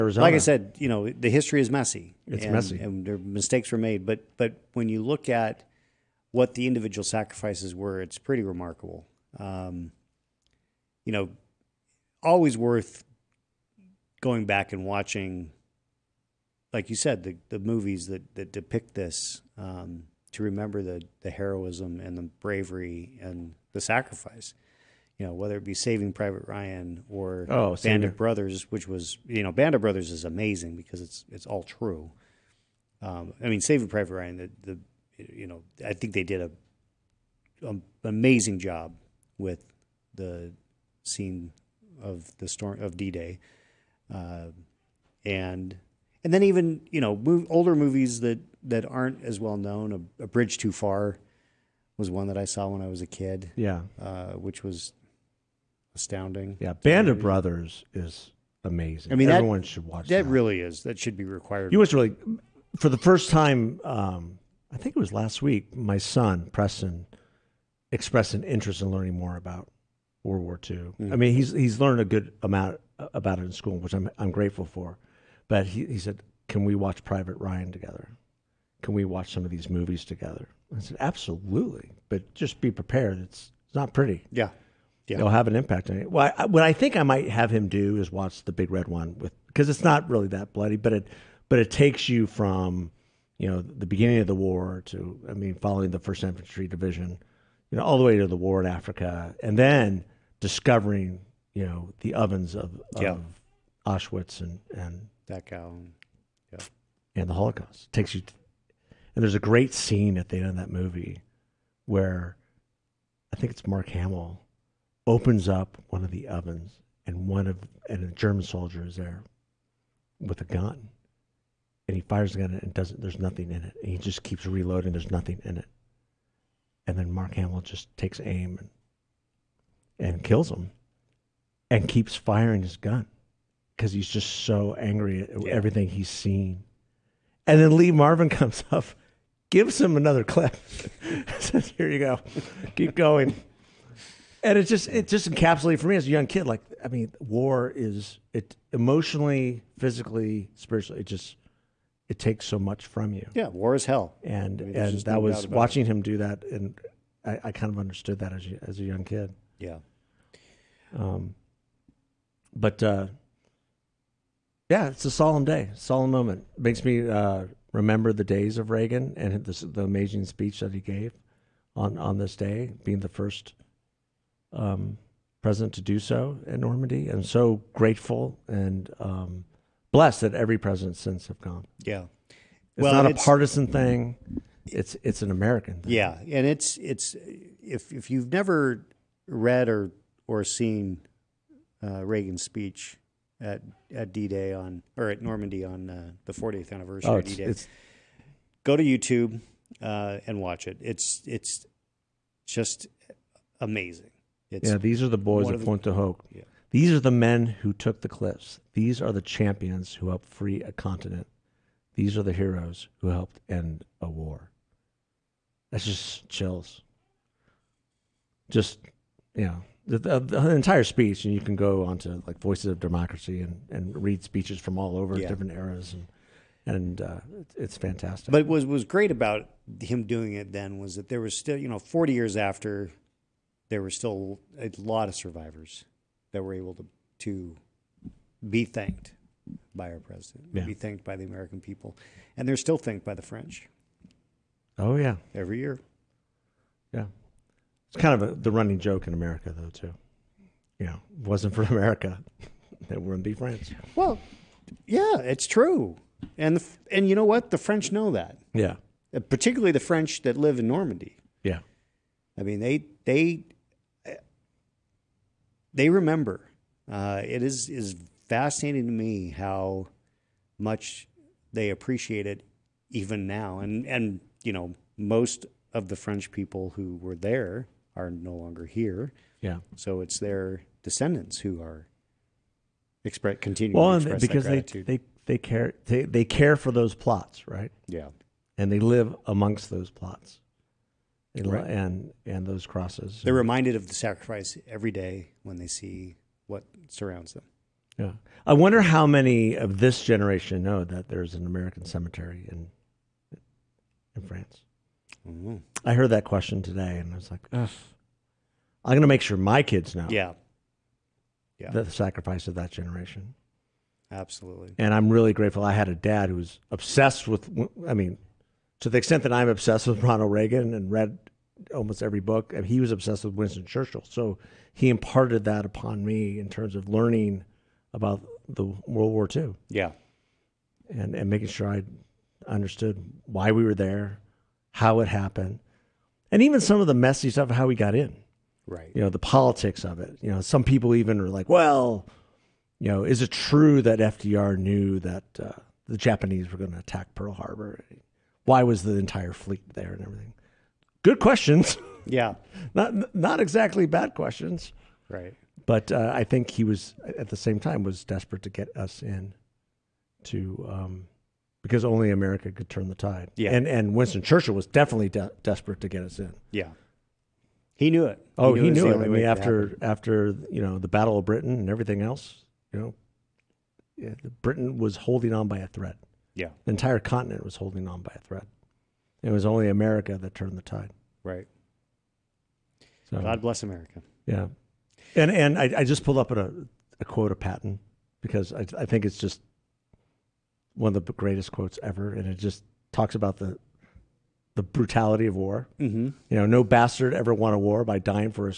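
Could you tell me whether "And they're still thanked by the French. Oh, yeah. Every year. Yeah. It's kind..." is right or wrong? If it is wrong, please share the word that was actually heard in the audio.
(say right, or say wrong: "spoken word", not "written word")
right.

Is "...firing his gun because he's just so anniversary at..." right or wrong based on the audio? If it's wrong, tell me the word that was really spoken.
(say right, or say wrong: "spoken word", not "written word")
wrong: "angry", not "anniversary".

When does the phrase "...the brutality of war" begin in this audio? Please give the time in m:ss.
6:34.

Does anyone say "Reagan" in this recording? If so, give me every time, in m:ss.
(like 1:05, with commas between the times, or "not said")
2:48, 3:12, 5:20.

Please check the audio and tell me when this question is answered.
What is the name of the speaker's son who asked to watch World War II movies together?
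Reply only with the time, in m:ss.
1:06.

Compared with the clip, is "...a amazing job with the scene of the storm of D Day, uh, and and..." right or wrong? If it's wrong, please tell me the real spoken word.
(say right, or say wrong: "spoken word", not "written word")
right.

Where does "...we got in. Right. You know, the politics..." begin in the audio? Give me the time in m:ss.
5:37.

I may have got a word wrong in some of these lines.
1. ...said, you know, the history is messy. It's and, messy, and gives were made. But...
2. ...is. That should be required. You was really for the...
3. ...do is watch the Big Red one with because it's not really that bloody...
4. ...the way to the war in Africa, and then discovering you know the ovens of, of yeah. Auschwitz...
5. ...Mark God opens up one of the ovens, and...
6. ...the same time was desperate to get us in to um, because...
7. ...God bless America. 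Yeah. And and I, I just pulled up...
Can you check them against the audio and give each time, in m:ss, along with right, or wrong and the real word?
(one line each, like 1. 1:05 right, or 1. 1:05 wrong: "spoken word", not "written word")
1. 0:00 wrong: "mistakes", not "gives"
2. 1:00 right
3. 1:27 right
4. 1:37 right
5. 1:53 wrong: "Hamill", not "God"
6. 5:57 right
7. 6:23 right.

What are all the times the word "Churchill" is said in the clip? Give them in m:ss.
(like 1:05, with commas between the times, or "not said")
5:23, 6:04.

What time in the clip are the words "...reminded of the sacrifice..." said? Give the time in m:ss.
4:53.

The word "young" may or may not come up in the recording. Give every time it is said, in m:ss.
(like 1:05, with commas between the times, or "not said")
2:26, 2:38.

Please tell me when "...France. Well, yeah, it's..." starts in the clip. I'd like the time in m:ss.
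4:13.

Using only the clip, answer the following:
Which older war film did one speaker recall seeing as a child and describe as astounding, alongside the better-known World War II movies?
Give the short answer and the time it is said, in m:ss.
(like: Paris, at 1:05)
A Bridge Too Far, at 0:50.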